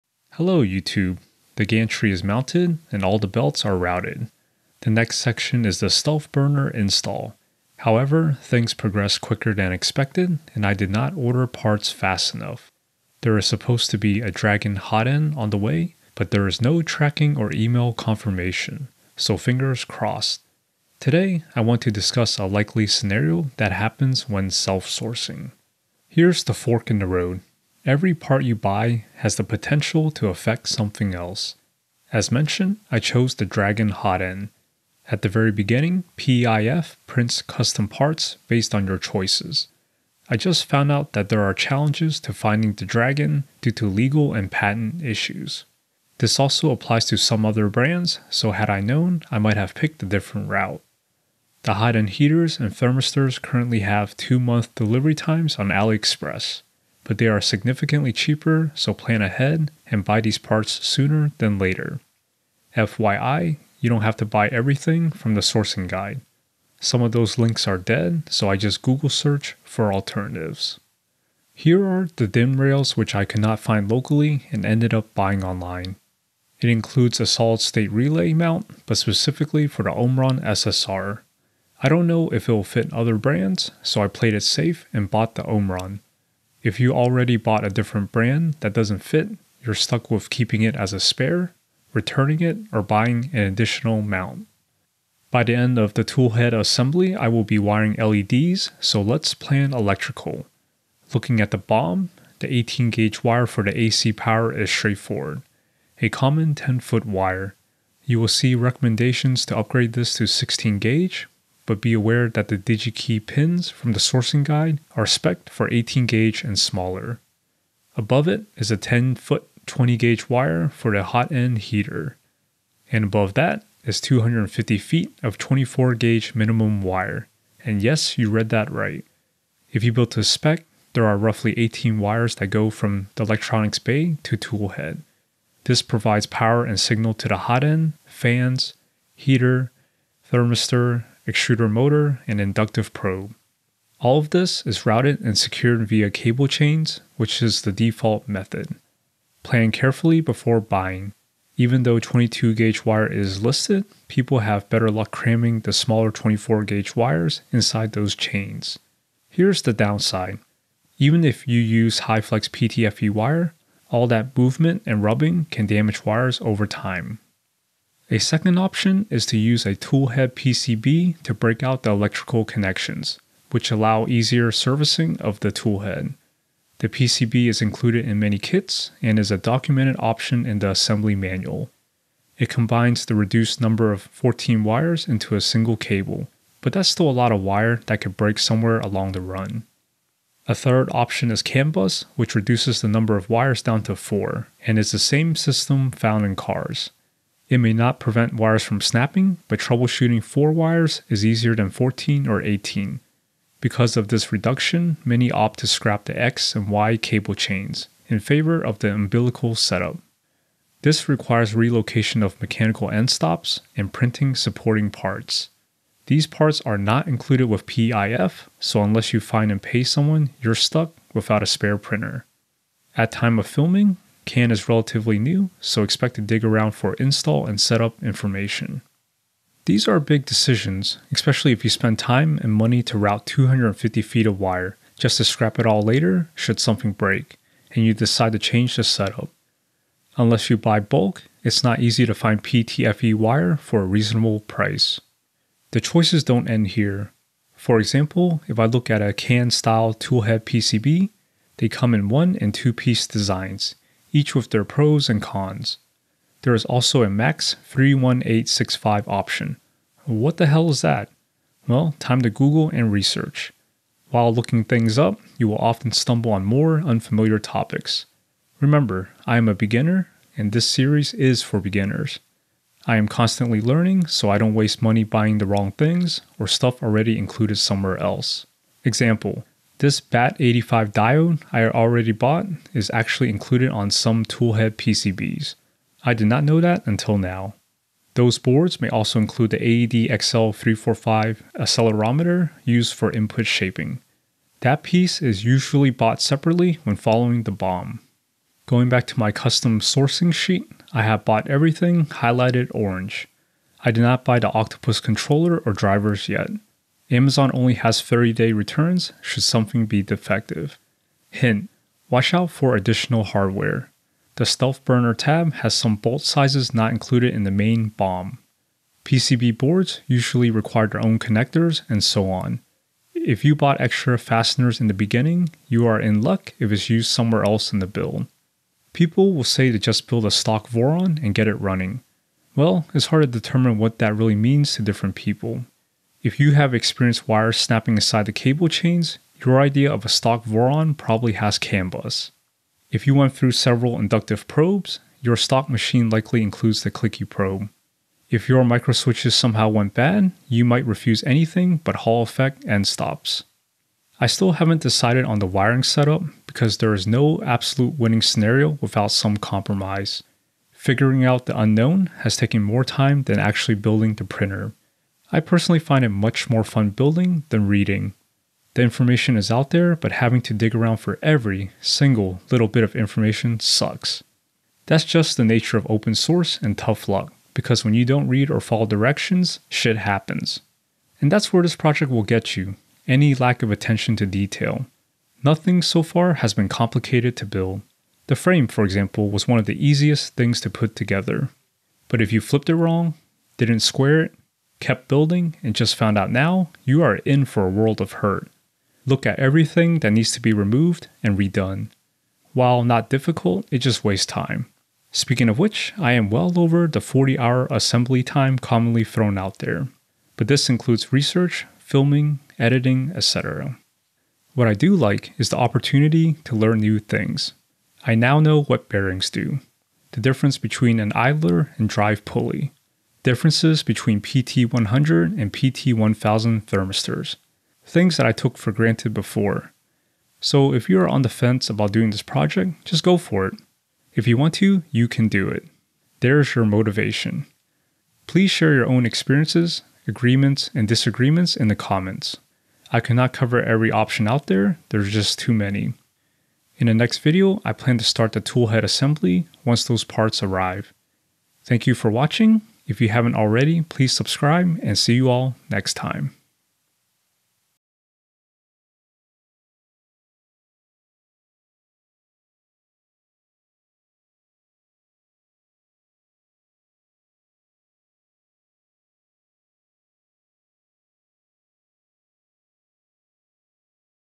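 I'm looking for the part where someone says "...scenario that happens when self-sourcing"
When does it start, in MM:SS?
00:22.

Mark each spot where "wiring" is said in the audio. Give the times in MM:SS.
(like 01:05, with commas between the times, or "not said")
01:37, 05:55.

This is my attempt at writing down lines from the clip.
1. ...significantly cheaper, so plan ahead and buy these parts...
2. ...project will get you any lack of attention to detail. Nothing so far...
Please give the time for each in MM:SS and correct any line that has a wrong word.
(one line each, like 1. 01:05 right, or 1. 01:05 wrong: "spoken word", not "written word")
1. 00:57 right
2. 06:21 right.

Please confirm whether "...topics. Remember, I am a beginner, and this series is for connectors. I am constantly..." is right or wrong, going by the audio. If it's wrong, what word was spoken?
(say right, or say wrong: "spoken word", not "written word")
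wrong: "beginners", not "connectors".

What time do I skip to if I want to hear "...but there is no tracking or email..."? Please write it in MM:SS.
00:16.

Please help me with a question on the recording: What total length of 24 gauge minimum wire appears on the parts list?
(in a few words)
250 feet.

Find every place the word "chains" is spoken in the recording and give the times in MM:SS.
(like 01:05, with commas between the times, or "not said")
02:26, 02:38, 03:27, 05:38.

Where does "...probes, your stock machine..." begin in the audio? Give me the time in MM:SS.
05:44.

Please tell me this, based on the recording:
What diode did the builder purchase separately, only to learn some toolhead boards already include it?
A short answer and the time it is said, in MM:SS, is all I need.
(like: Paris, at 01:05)
BAT85, at 04:39.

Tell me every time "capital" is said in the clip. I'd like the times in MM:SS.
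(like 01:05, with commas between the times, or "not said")
not said.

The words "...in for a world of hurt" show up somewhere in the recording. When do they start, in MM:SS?
06:37.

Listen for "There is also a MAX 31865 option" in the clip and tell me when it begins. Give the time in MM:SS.
04:16.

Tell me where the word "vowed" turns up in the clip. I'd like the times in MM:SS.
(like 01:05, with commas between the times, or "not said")
not said.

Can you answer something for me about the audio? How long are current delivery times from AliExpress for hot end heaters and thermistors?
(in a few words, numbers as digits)
2 months.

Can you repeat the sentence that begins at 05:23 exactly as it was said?
If you bought extra fasteners in the beginning, you are in luck if it's used somewhere else in the build.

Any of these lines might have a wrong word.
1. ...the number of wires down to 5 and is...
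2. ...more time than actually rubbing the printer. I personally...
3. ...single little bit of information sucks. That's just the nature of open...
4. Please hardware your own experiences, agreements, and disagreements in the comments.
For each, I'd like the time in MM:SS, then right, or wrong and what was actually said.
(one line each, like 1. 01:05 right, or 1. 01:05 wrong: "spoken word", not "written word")
1. 03:12 wrong: "4", not "5"
2. 06:02 wrong: "building", not "rubbing"
3. 06:11 right
4. 07:18 wrong: "share", not "hardware".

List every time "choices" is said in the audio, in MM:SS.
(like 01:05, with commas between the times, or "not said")
00:38, 04:05.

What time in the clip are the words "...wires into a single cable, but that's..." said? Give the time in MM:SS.
03:04.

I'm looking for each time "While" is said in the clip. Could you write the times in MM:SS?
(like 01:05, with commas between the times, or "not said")
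04:24, 06:42.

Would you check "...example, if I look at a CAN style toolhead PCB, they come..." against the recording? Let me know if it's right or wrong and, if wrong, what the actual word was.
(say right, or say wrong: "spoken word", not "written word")
right.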